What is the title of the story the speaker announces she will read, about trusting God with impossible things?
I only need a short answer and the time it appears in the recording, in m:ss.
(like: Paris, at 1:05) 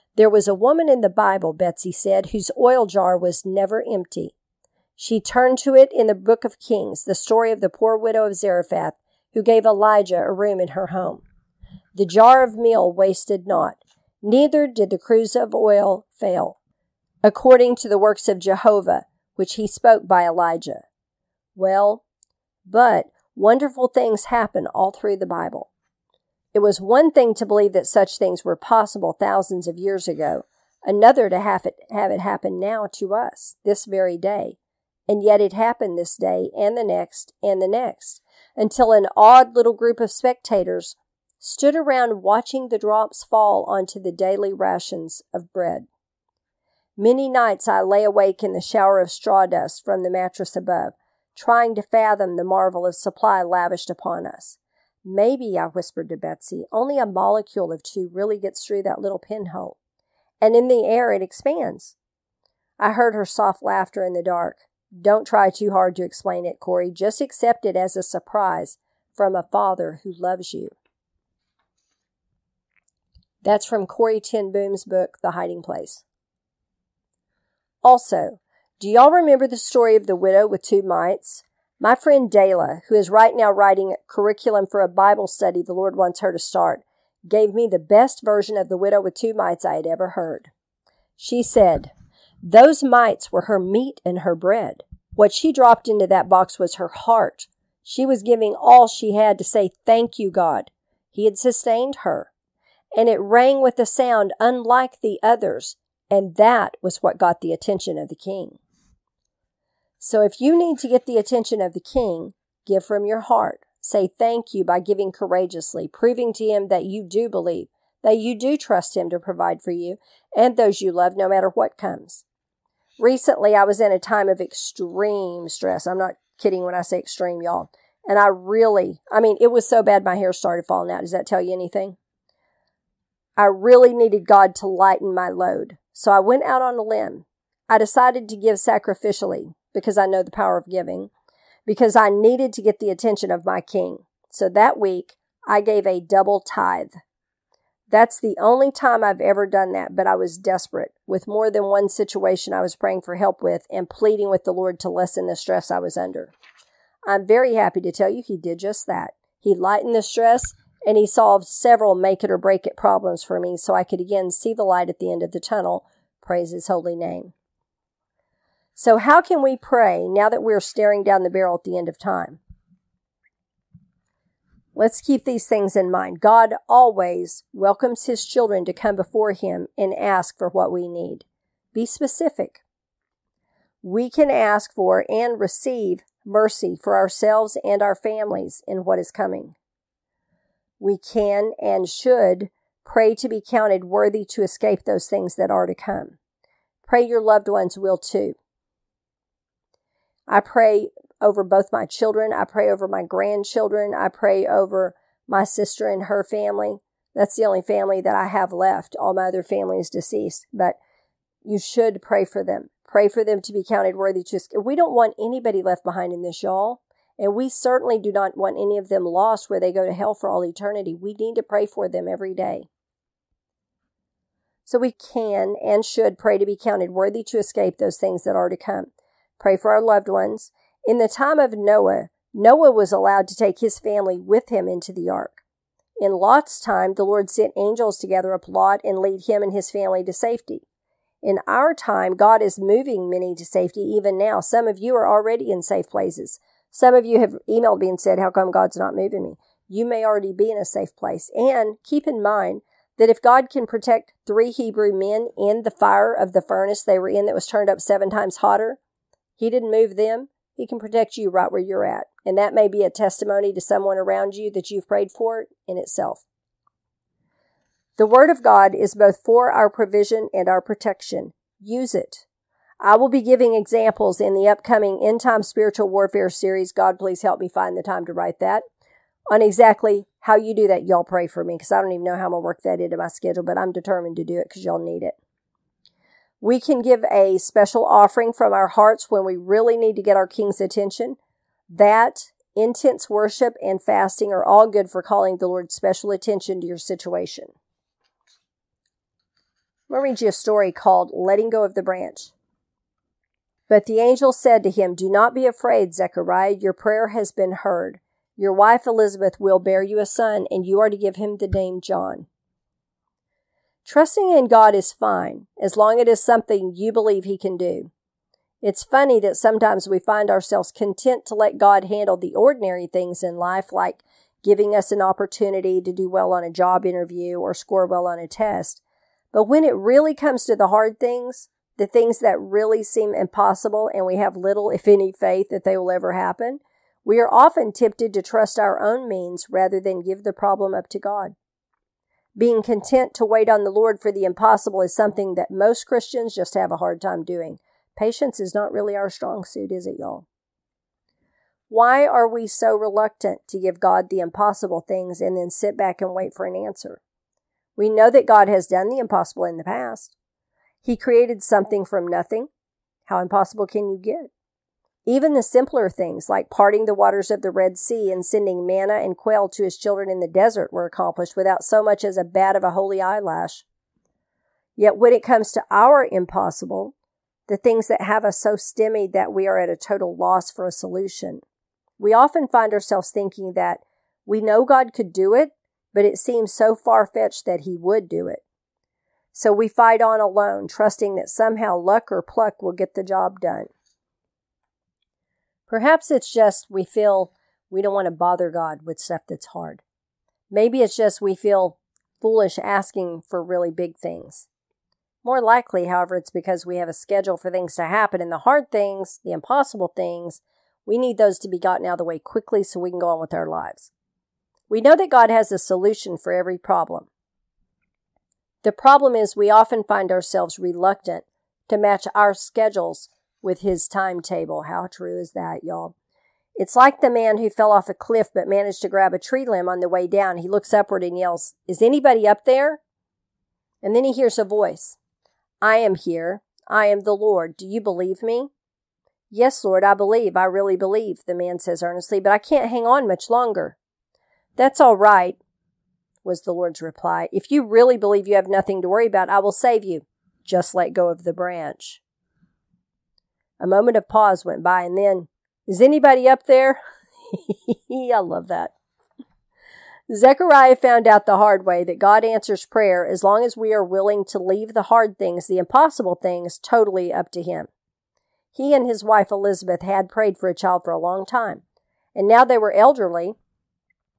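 Letting Go of the Branch, at 5:01.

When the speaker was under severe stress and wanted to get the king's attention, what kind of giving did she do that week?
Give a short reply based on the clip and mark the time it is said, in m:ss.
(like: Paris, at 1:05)
A double tithe, at 2:25.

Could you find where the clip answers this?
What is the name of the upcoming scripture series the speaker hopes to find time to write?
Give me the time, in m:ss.
4:35.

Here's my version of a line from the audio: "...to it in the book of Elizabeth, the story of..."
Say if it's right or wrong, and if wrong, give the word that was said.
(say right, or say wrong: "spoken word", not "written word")
wrong: "Kings", not "Elizabeth".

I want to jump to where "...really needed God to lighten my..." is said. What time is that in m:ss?
2:13.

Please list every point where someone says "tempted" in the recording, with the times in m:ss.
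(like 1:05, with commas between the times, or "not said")
5:37.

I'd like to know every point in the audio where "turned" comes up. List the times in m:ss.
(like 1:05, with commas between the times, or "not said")
0:05, 4:17.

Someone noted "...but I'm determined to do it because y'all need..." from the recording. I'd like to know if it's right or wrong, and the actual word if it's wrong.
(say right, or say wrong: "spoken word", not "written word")
right.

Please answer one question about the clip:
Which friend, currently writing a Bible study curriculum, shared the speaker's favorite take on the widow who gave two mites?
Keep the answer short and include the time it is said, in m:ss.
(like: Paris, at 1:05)
Dayla, at 1:22.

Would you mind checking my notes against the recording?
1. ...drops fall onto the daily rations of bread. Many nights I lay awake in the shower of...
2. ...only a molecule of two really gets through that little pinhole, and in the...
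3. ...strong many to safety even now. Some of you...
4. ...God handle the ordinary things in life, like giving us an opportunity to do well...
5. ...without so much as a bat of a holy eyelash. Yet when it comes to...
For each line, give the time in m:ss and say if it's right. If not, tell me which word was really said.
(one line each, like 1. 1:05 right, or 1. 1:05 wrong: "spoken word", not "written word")
1. 0:42 right
2. 0:56 right
3. 4:02 wrong: "moving", not "strong"
4. 5:21 right
5. 6:11 right.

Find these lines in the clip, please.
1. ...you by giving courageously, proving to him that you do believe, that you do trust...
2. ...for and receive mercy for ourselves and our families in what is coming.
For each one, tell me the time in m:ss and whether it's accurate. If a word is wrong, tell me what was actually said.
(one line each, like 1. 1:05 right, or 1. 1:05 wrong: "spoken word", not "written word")
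1. 1:54 right
2. 3:04 right.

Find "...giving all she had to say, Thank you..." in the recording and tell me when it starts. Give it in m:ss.
1:38.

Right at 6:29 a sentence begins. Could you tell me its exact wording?
So we fight on alone, trusting that somehow luck or pluck will get the job done.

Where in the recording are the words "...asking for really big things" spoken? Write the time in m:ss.
6:42.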